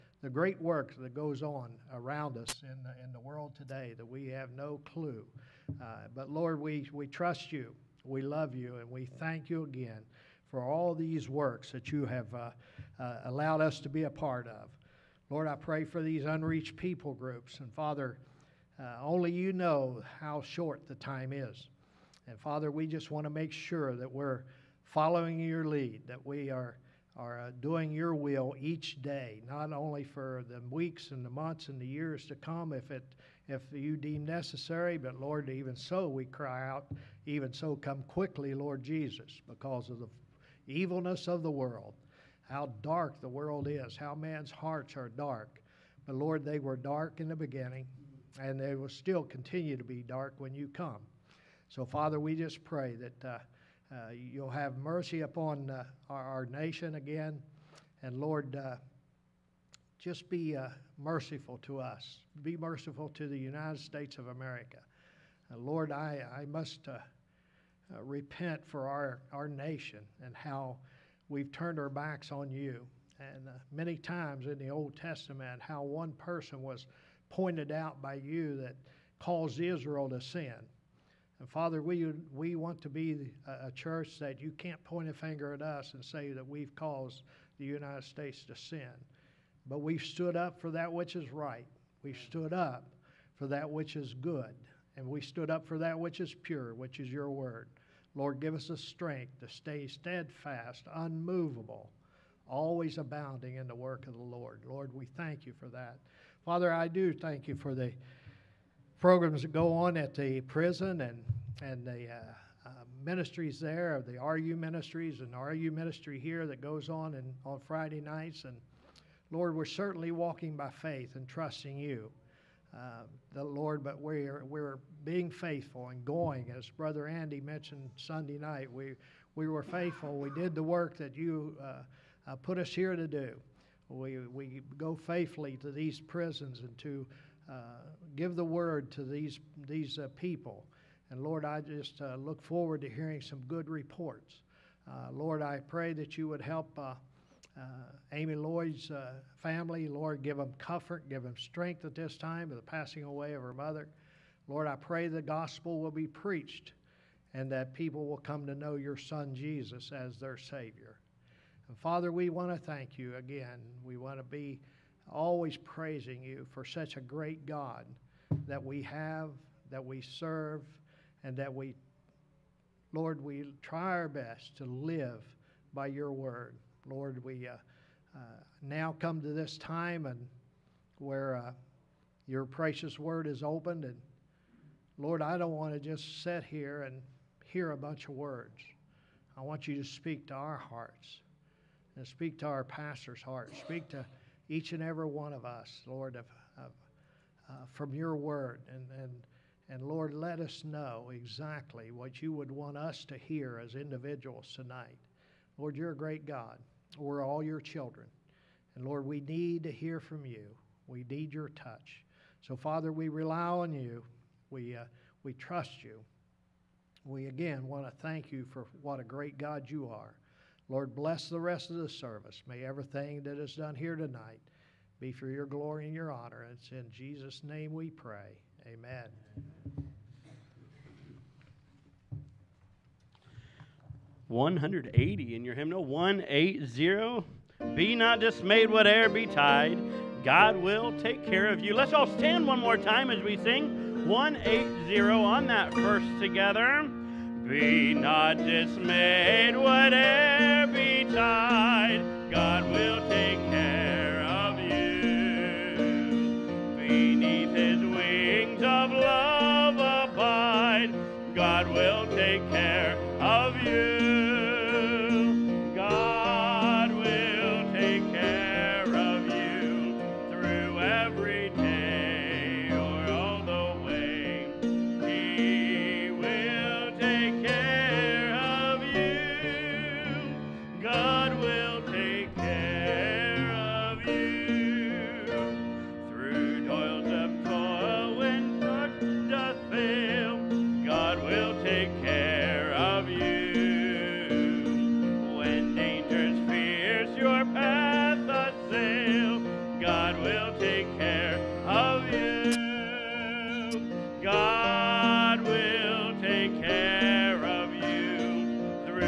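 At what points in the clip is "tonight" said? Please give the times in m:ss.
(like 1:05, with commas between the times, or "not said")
3:24, 3:43.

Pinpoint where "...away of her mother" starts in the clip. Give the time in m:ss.
2:33.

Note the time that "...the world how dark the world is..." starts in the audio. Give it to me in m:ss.
0:41.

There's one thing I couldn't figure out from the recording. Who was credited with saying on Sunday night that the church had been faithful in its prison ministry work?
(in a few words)
Brother Andy.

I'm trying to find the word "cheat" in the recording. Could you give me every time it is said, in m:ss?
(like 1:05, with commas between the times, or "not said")
not said.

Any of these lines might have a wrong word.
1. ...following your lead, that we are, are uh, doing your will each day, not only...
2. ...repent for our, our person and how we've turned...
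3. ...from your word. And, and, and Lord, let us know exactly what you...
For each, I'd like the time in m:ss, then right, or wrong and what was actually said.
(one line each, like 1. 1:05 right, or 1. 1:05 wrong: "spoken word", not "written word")
1. 0:24 right
2. 1:07 wrong: "nation", not "person"
3. 3:17 right.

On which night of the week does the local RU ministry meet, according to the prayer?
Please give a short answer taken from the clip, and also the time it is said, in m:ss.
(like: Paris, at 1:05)
Friday nights, at 1:57.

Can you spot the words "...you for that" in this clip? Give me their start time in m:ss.
1:45.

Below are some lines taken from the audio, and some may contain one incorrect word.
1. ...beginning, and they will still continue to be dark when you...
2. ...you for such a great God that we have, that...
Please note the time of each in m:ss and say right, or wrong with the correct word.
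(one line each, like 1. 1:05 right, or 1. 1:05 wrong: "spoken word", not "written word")
1. 0:47 right
2. 2:46 right.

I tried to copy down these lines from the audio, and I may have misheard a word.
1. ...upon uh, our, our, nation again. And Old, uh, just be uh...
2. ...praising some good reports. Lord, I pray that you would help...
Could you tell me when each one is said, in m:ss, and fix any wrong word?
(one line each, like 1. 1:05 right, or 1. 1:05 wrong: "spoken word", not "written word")
1. 0:55 wrong: "Lord", not "Old"
2. 2:22 wrong: "hearing", not "praising".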